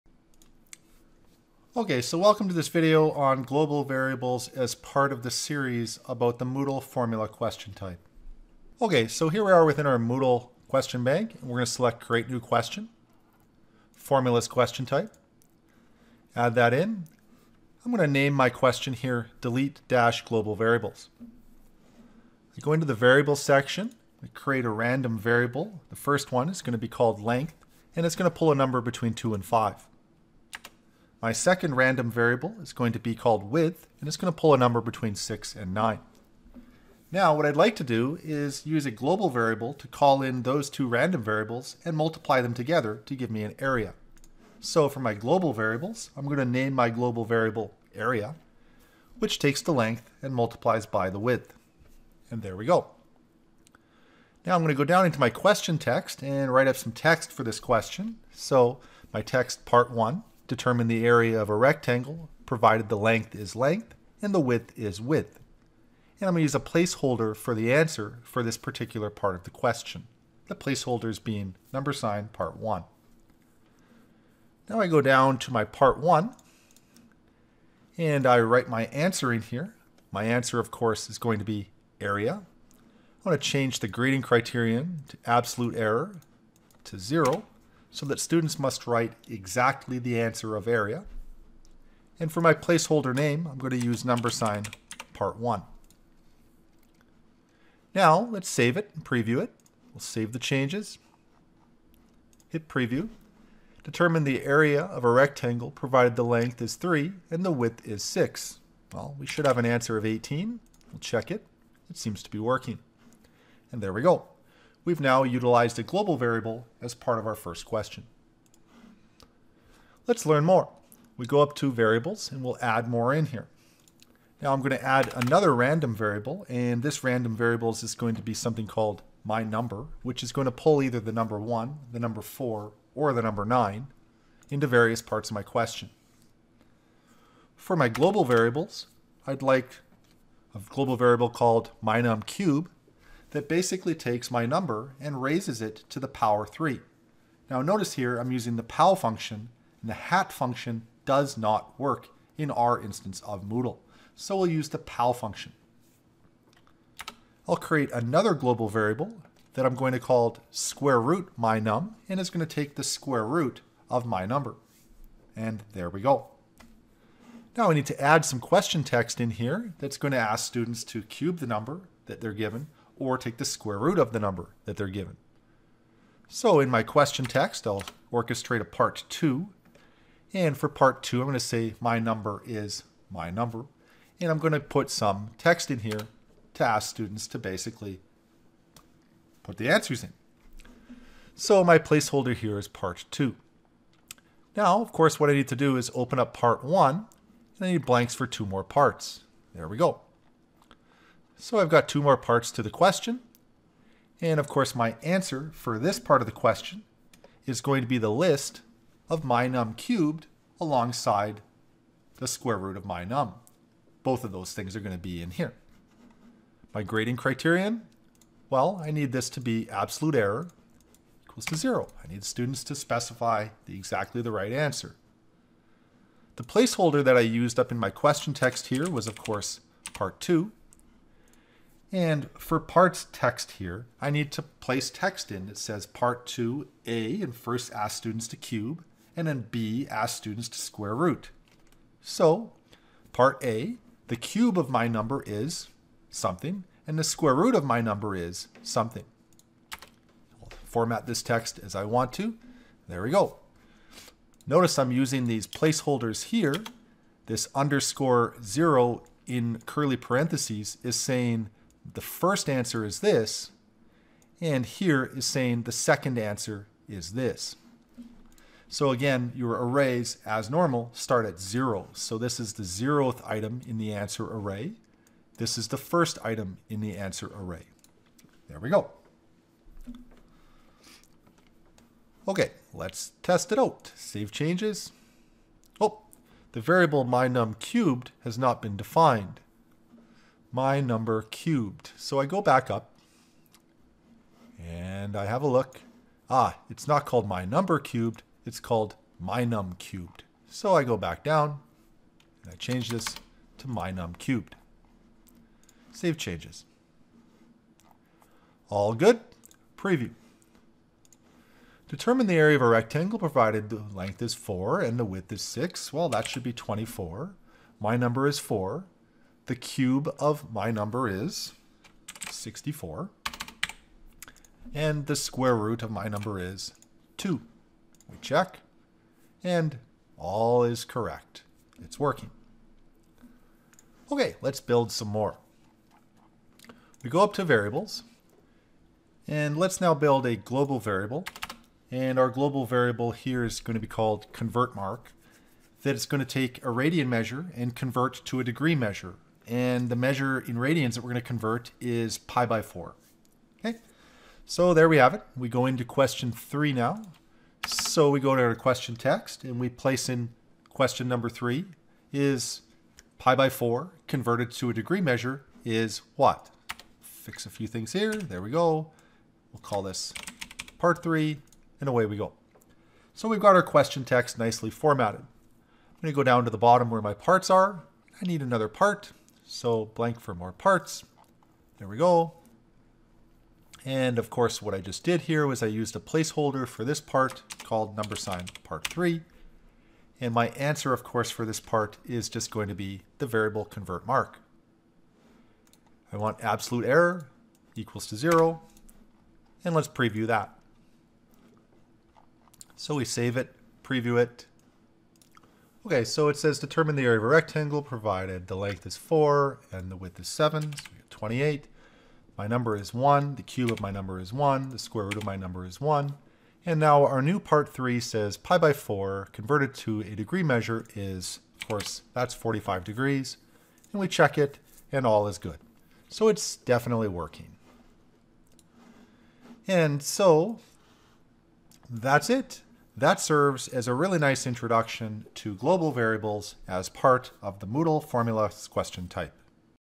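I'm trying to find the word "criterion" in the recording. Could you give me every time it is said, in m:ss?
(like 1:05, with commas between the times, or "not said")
1:24, 3:37.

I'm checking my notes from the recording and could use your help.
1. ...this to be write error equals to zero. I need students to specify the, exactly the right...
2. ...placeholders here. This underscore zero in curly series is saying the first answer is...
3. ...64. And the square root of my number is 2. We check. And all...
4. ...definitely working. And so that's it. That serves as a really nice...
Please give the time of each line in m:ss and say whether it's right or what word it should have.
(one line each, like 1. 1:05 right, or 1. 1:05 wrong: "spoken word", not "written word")
1. 3:39 wrong: "absolute", not "write"
2. 4:15 wrong: "parentheses", not "series"
3. 5:22 right
4. 7:06 right.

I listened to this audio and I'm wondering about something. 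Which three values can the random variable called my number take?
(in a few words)
1, 4, or 9.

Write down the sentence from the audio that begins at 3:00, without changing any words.
And for part 2, I'm going to say my number is my number.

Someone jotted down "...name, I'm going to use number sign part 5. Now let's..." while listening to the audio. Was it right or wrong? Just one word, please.
wrong.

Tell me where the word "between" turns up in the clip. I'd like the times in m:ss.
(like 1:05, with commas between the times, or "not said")
0:28, 0:34.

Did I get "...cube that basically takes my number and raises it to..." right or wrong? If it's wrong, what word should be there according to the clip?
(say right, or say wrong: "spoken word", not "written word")
right.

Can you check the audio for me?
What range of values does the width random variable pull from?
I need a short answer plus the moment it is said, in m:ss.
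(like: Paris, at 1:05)
6 to 9, at 0:34.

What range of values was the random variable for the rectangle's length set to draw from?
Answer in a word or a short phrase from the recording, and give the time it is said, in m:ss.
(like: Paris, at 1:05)
2 to 5, at 0:28.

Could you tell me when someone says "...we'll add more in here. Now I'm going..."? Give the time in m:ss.
2:02.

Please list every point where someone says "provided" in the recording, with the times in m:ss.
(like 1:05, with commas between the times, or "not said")
1:02, 1:45, 5:13, 6:47.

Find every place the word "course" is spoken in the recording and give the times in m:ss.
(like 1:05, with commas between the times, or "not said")
1:20, 3:14, 3:24, 3:49, 6:24, 6:31, 7:01.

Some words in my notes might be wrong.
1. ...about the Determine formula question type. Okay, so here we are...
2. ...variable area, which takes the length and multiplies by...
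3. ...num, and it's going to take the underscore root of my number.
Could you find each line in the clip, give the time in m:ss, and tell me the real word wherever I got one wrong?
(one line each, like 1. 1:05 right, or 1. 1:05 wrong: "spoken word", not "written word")
1. 0:06 wrong: "Moodle", not "Determine"
2. 0:47 right
3. 2:41 wrong: "square", not "underscore".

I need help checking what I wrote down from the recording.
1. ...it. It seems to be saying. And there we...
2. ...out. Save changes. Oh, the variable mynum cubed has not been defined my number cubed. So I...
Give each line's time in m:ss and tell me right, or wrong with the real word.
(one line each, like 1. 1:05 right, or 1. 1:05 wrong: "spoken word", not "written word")
1. 1:51 wrong: "working", not "saying"
2. 4:43 right.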